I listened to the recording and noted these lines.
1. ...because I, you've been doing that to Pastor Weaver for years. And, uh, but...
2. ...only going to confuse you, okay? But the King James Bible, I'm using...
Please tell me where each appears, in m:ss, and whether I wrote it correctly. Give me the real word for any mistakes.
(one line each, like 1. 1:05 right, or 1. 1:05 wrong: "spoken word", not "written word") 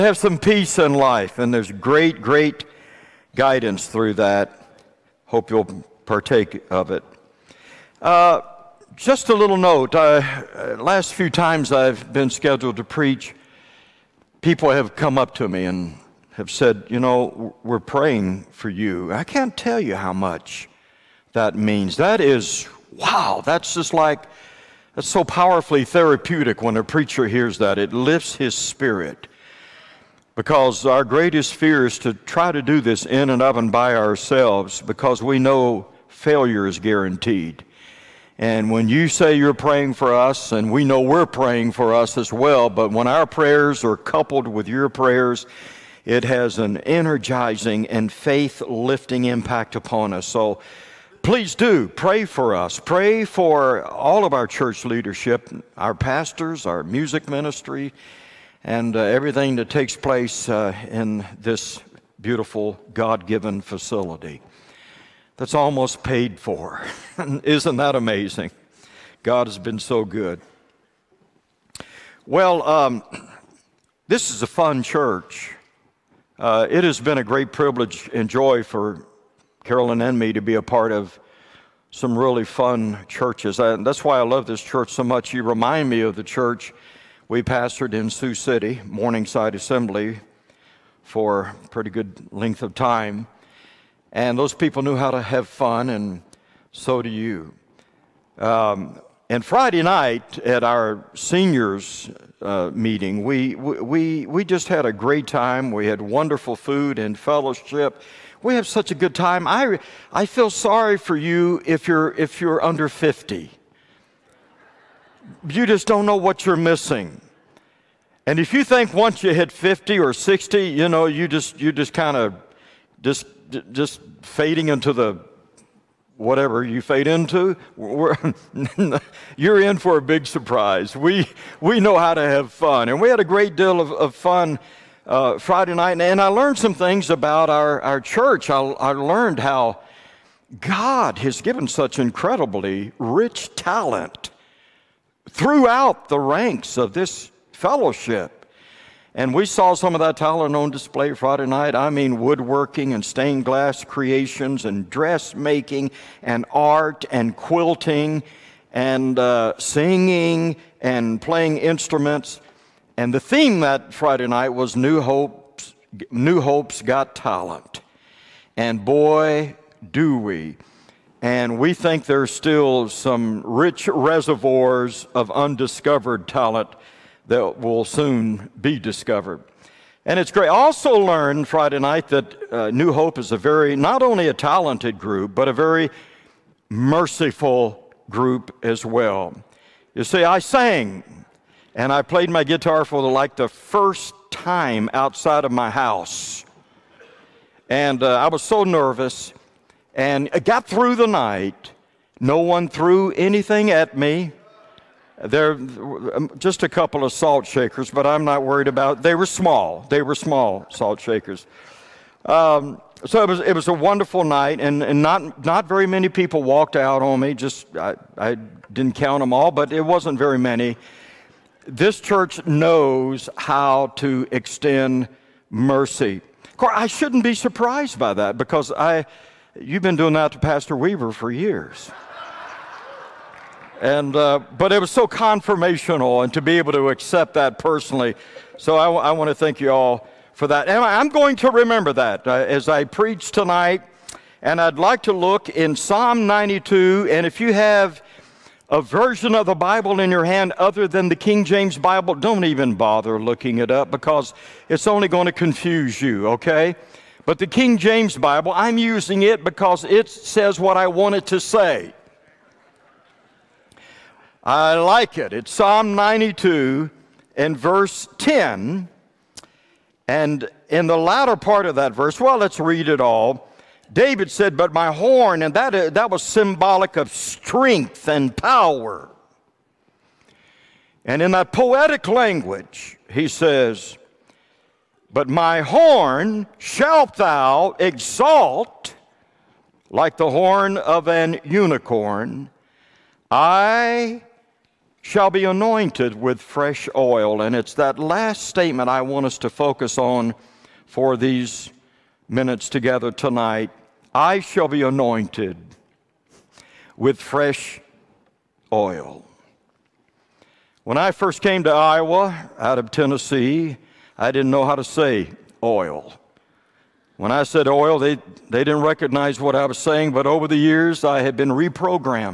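1. 3:48 right
2. 4:14 right.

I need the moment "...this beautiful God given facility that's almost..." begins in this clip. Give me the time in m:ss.
1:01.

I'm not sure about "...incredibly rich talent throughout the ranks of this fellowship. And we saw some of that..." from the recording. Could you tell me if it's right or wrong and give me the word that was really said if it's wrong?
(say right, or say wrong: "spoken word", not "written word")
right.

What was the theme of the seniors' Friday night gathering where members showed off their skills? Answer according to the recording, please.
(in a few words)
New Hope's Got Talent.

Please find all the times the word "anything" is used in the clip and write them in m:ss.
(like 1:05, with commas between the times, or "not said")
3:23.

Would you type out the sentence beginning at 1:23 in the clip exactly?
And that's why I love this church so much.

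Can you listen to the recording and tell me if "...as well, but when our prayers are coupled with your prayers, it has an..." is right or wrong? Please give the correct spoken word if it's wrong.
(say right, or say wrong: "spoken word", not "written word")
right.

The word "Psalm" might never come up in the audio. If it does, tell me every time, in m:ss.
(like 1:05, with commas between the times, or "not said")
4:05, 4:25.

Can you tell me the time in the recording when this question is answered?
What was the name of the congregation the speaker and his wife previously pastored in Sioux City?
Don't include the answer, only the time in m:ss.
1:28.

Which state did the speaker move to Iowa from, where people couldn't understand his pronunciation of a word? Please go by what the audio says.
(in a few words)
Tennessee.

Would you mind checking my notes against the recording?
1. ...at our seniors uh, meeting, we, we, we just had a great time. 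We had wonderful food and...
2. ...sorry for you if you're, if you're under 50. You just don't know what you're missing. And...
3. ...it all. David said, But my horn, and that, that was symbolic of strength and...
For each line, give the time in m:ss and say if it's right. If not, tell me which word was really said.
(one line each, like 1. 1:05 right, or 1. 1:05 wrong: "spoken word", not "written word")
1. 1:40 right
2. 1:50 right
3. 4:32 right.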